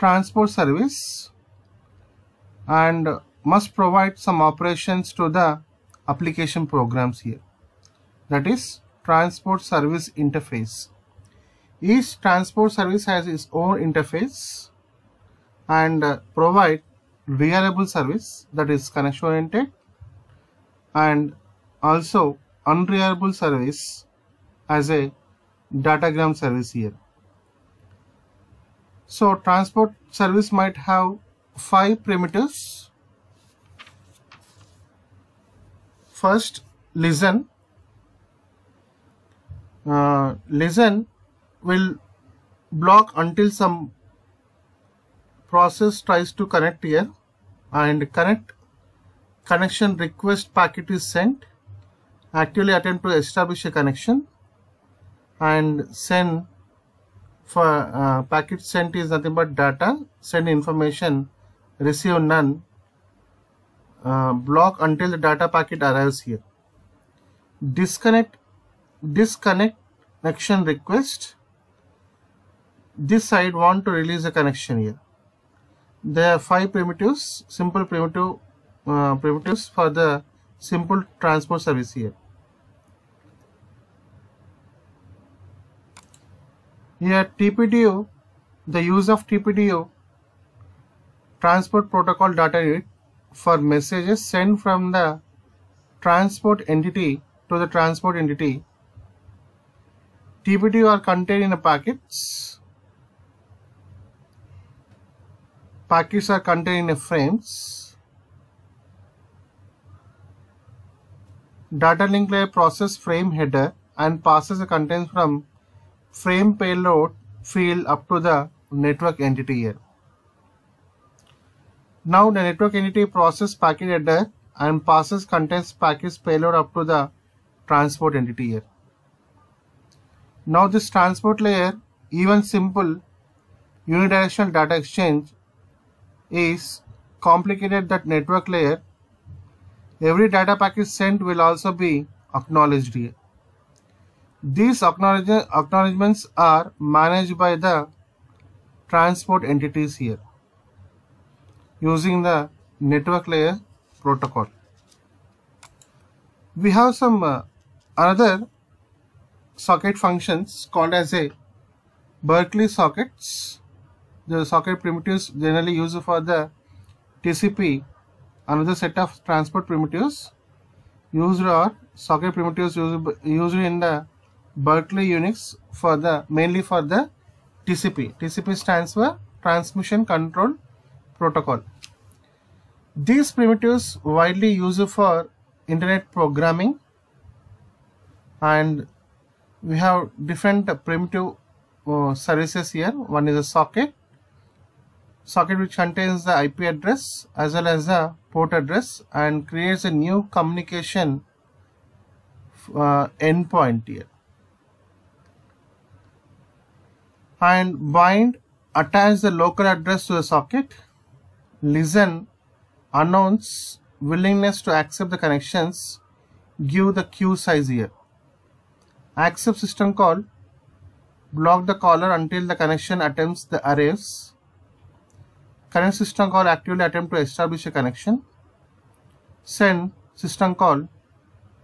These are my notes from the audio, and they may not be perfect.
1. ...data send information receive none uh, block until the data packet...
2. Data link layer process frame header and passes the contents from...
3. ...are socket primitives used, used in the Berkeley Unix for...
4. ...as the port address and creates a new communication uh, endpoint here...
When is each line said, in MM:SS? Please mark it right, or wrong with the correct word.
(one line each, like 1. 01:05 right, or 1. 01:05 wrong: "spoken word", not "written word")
1. 00:59 right
2. 01:51 right
3. 02:51 right
4. 03:17 right.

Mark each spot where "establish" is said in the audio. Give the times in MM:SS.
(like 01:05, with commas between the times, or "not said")
00:53, 03:47.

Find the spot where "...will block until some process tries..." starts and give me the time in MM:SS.
00:41.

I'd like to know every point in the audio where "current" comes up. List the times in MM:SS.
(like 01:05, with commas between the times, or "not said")
03:45.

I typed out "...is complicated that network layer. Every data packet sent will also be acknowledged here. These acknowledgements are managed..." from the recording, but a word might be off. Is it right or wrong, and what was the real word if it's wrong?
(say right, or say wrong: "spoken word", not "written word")
right.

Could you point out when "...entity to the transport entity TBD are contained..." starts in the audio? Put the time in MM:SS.
01:36.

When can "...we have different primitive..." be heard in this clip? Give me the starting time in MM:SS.
03:09.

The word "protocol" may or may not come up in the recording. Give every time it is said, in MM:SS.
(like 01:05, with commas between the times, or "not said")
01:31, 02:34, 03:01.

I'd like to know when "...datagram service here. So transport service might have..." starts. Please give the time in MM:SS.
00:25.